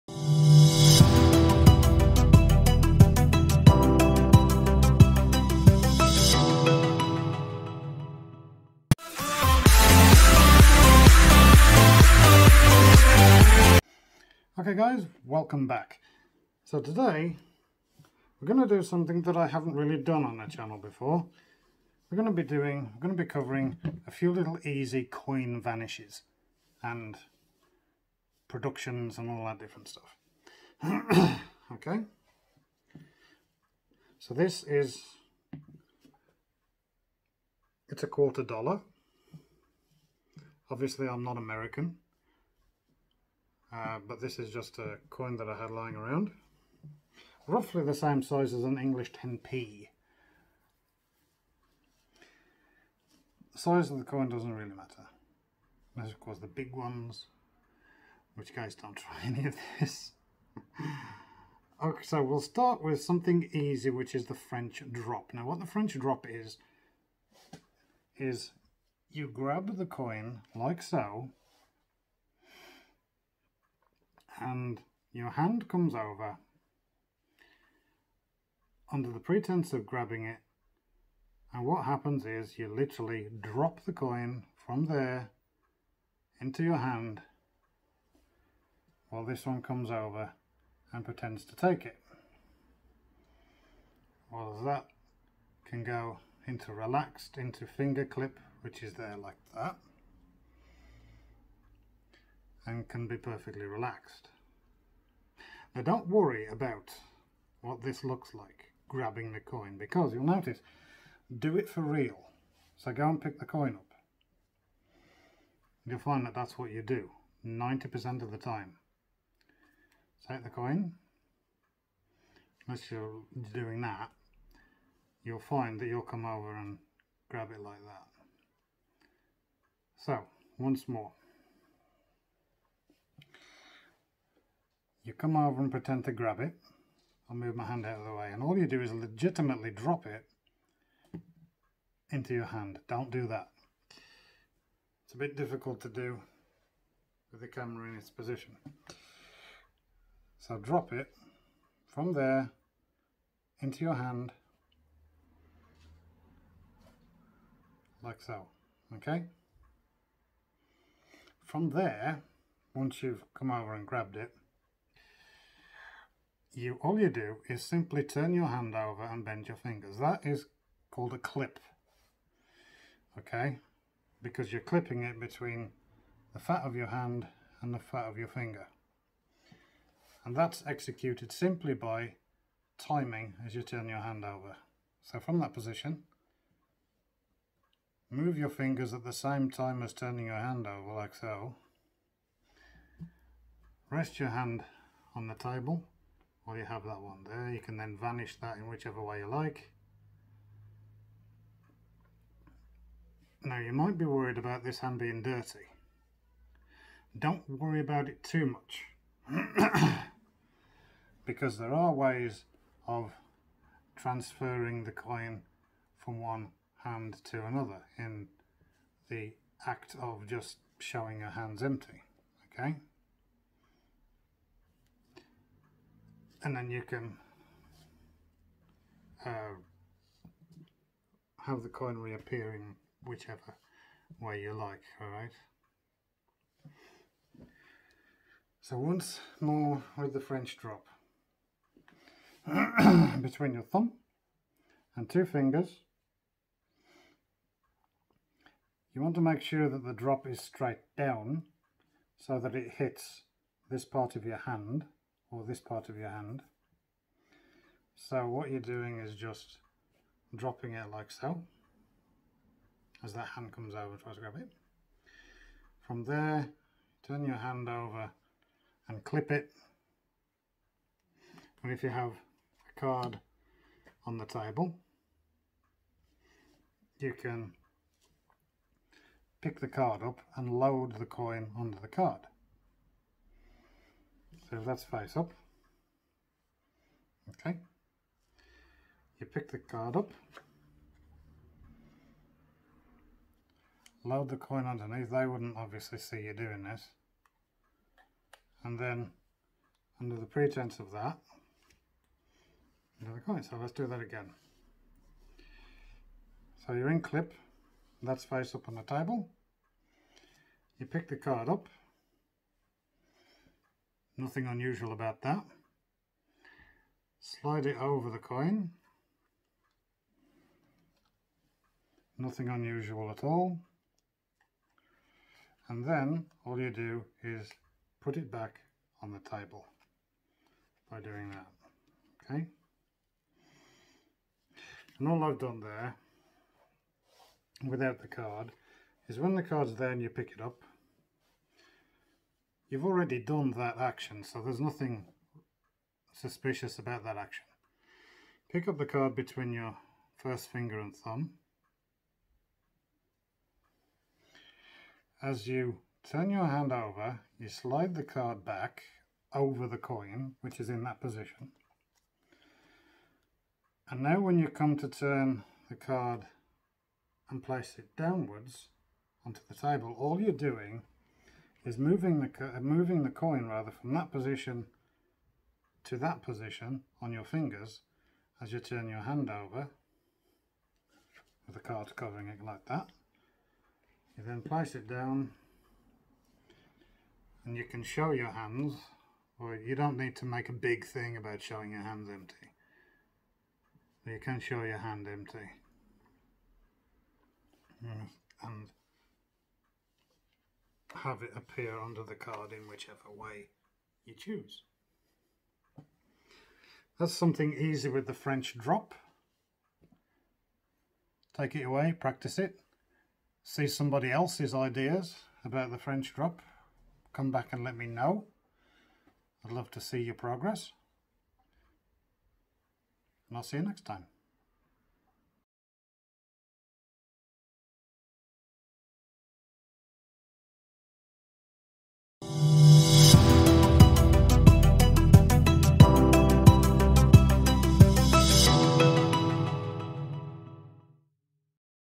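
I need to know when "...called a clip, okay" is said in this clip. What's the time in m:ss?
2:50.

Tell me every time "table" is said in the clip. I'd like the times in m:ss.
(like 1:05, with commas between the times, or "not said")
3:15, 4:34, 5:08, 5:29, 6:09.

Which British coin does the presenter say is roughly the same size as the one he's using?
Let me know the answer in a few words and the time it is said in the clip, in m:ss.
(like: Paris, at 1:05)
English 10p, at 0:48.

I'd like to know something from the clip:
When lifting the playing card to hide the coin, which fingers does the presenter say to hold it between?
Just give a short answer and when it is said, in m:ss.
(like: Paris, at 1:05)
First finger and thumb, at 5:50.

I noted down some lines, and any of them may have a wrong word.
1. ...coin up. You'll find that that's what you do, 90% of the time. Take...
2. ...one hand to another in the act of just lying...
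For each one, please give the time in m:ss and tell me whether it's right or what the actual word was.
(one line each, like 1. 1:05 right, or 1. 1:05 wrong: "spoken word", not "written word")
1. 1:53 right
2. 3:36 wrong: "showing", not "lying".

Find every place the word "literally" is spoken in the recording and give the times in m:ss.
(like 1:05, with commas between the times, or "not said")
1:22.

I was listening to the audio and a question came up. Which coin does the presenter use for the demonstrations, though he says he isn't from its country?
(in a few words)
Quarter dollar.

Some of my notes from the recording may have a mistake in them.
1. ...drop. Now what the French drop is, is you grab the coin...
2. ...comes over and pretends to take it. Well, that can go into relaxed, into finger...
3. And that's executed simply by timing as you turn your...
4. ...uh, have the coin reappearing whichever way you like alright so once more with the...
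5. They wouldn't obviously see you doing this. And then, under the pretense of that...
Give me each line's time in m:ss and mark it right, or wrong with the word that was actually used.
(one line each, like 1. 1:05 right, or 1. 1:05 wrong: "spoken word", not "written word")
1. 1:04 right
2. 1:29 right
3. 3:00 right
4. 3:49 right
5. 4:55 right.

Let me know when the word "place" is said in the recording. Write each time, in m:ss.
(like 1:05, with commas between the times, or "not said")
6:07, 6:24.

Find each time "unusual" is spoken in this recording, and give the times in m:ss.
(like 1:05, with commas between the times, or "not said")
5:14, 5:22.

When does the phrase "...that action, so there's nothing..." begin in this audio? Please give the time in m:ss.
5:43.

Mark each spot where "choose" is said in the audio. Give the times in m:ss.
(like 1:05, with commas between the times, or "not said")
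6:44.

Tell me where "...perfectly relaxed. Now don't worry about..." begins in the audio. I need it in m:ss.
1:43.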